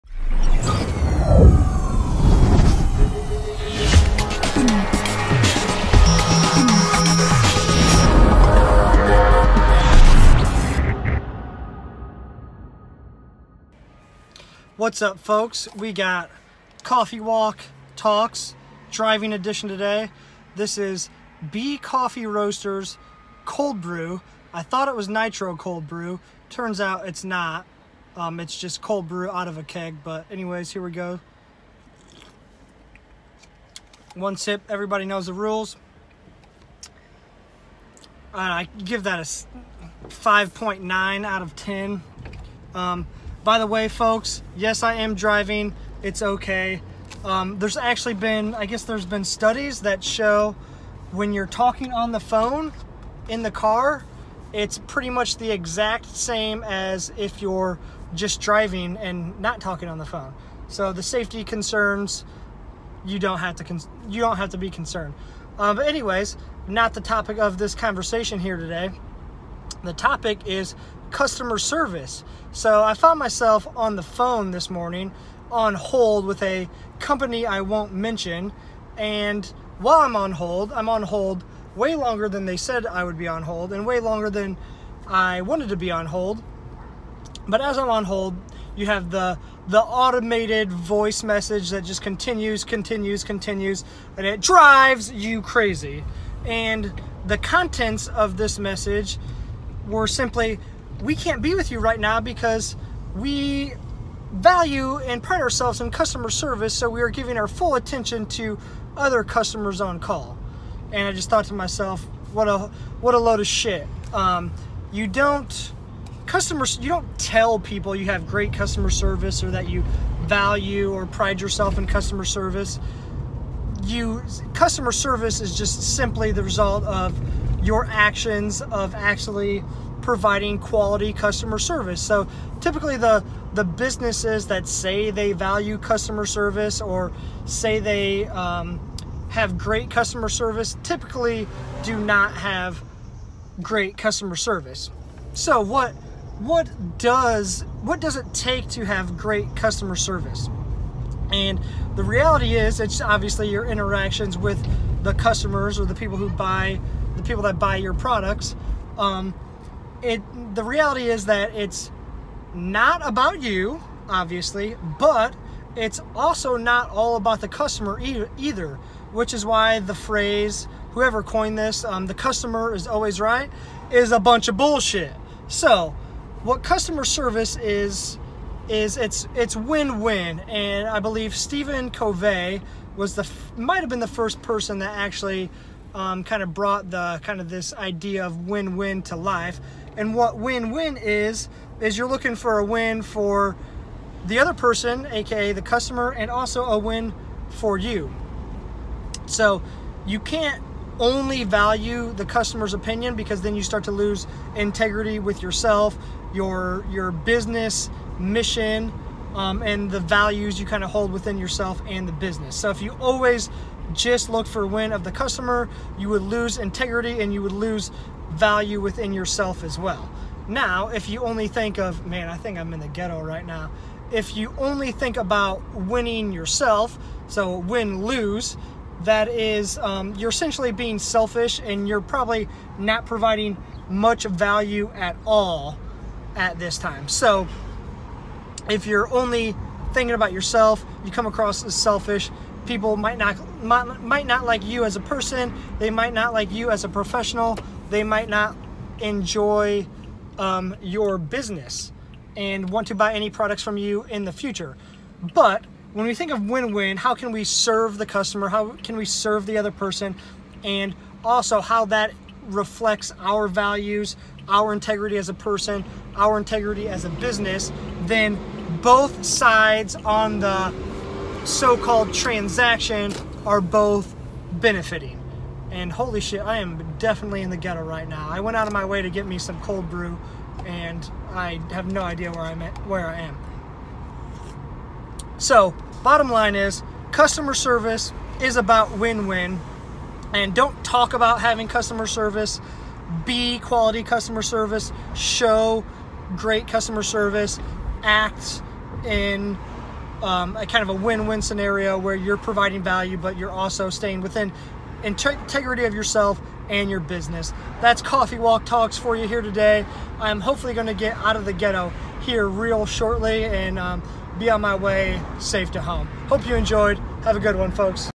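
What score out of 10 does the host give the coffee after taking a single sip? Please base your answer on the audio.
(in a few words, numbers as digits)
5.9.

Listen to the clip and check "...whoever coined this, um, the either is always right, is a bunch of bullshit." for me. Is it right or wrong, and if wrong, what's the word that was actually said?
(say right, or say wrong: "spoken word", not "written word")
wrong: "customer", not "either".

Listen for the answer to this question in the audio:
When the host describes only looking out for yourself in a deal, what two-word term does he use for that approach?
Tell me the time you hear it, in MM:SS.
03:47.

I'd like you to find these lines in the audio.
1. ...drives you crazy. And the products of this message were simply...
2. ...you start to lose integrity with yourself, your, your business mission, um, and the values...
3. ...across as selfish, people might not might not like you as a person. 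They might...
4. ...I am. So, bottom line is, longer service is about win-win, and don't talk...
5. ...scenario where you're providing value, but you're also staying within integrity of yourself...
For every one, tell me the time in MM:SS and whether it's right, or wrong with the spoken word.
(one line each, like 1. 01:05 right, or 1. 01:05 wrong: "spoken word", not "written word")
1. 01:34 wrong: "contents", not "products"
2. 03:23 right
3. 04:01 right
4. 04:43 wrong: "customer", not "longer"
5. 05:01 right.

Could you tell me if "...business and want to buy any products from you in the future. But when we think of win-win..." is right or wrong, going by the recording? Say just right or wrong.
right.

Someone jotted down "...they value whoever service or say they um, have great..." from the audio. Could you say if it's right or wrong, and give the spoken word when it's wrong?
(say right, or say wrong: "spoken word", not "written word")
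wrong: "customer", not "whoever".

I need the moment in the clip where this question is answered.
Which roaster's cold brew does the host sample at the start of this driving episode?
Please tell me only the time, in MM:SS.
00:21.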